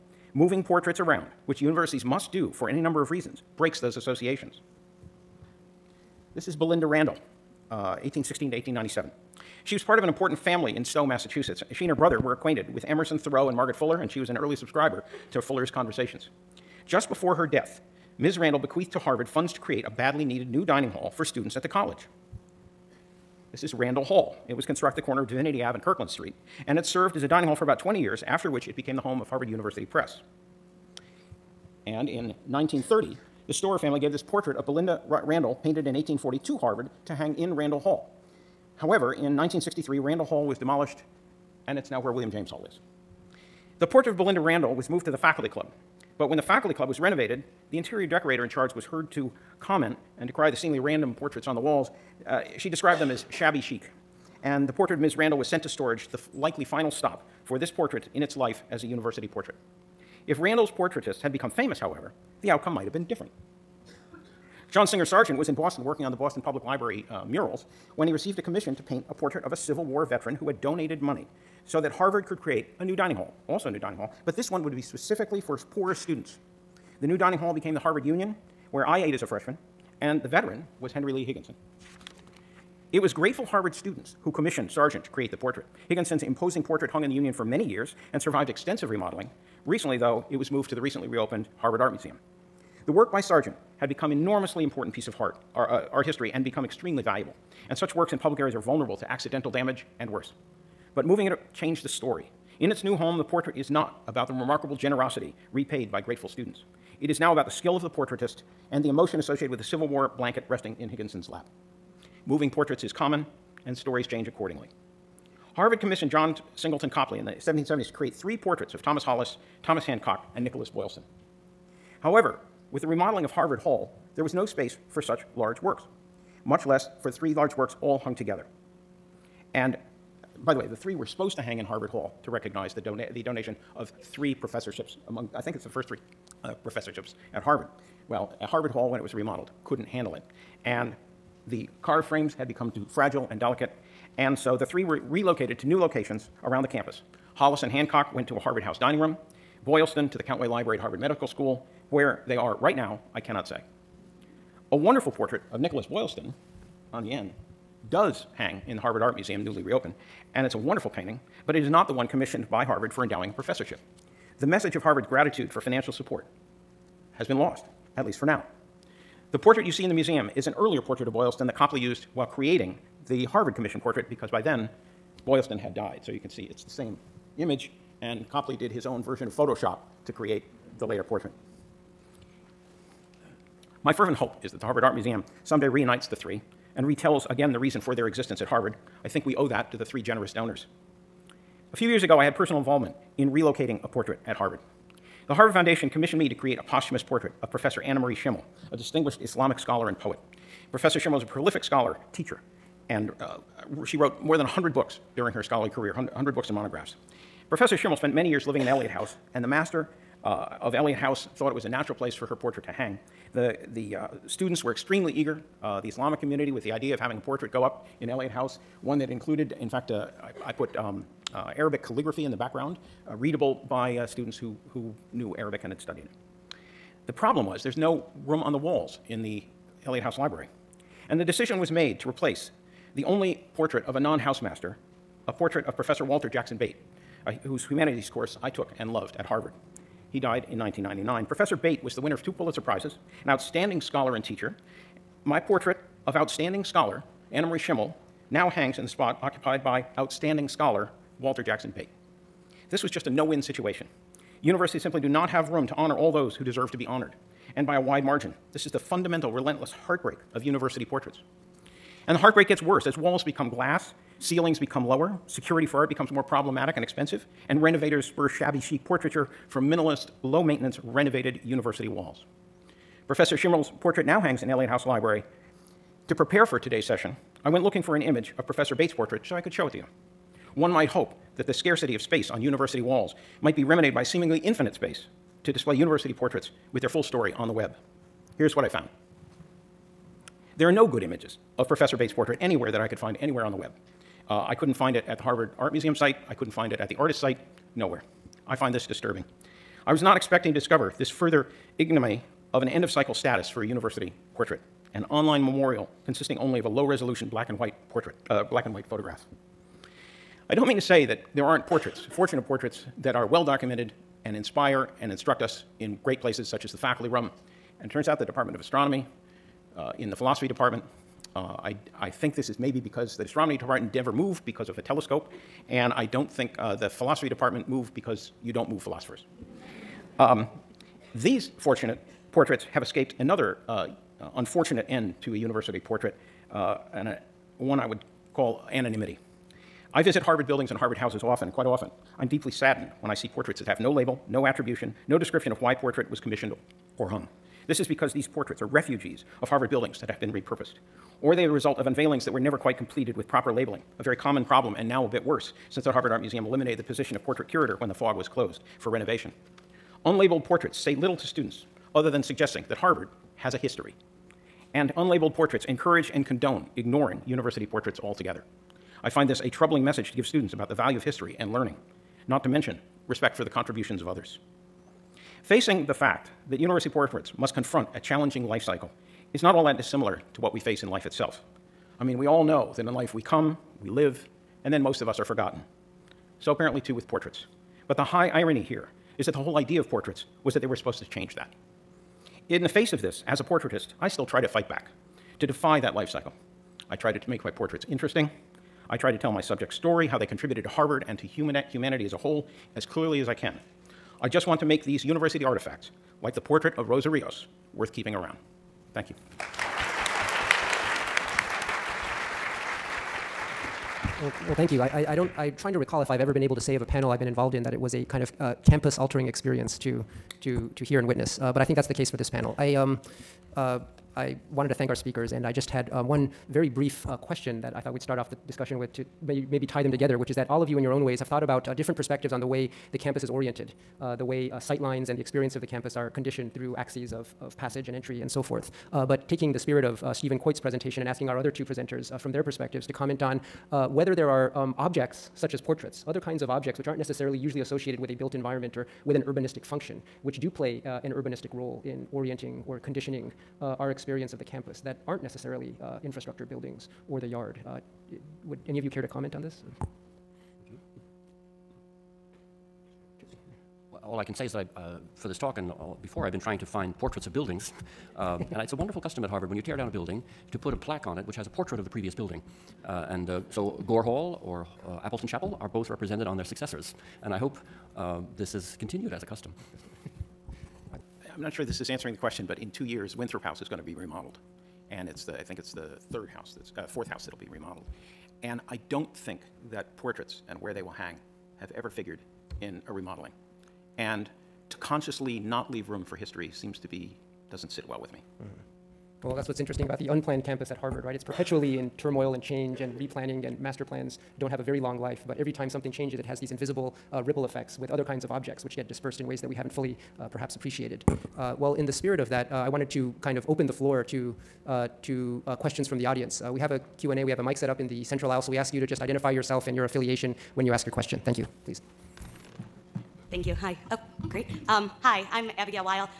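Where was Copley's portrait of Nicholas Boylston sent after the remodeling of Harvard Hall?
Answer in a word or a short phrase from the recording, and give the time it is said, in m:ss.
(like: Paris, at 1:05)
Countway Library, at 2:30.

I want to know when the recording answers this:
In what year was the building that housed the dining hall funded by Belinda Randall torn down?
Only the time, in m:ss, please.
0:39.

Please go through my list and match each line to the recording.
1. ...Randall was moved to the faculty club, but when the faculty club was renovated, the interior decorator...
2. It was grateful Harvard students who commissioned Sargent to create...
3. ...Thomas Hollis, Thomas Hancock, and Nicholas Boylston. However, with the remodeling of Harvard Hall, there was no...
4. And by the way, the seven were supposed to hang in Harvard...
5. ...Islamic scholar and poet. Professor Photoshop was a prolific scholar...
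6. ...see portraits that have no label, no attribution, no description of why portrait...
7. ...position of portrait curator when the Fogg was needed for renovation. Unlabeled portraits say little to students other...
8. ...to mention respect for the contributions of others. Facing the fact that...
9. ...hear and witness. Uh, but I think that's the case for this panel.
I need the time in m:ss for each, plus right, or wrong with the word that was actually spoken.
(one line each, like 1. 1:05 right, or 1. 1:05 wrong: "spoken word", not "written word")
1. 0:44 right
2. 1:22 right
3. 1:58 right
4. 2:09 wrong: "three", not "seven"
5. 3:19 wrong: "Sherman", not "Photoshop"
6. 5:43 right
7. 5:56 wrong: "closed", not "needed"
8. 6:12 right
9. 7:00 right.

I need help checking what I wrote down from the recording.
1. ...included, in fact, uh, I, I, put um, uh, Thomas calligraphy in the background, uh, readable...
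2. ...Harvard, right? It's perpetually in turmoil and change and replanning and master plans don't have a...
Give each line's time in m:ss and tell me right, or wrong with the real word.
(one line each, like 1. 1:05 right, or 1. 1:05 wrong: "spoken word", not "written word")
1. 3:39 wrong: "Arabic", not "Thomas"
2. 8:20 right.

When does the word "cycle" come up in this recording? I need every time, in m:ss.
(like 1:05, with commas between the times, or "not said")
5:02, 6:18, 6:36.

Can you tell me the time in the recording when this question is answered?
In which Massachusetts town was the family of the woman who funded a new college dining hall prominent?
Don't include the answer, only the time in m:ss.
0:10.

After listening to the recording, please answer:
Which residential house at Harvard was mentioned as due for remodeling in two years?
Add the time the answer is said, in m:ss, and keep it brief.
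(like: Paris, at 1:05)
Winthrop House, at 8:03.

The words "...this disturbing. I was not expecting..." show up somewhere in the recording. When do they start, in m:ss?
4:58.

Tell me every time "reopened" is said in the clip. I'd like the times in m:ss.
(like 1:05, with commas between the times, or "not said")
1:31, 2:39.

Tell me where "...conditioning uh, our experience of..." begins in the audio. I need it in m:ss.
7:32.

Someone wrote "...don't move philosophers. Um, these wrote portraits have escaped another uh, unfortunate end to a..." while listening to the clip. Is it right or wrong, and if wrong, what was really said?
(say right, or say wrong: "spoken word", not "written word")
wrong: "fortunate", not "wrote".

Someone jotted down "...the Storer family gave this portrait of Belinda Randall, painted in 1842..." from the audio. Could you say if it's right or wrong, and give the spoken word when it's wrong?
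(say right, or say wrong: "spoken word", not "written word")
right.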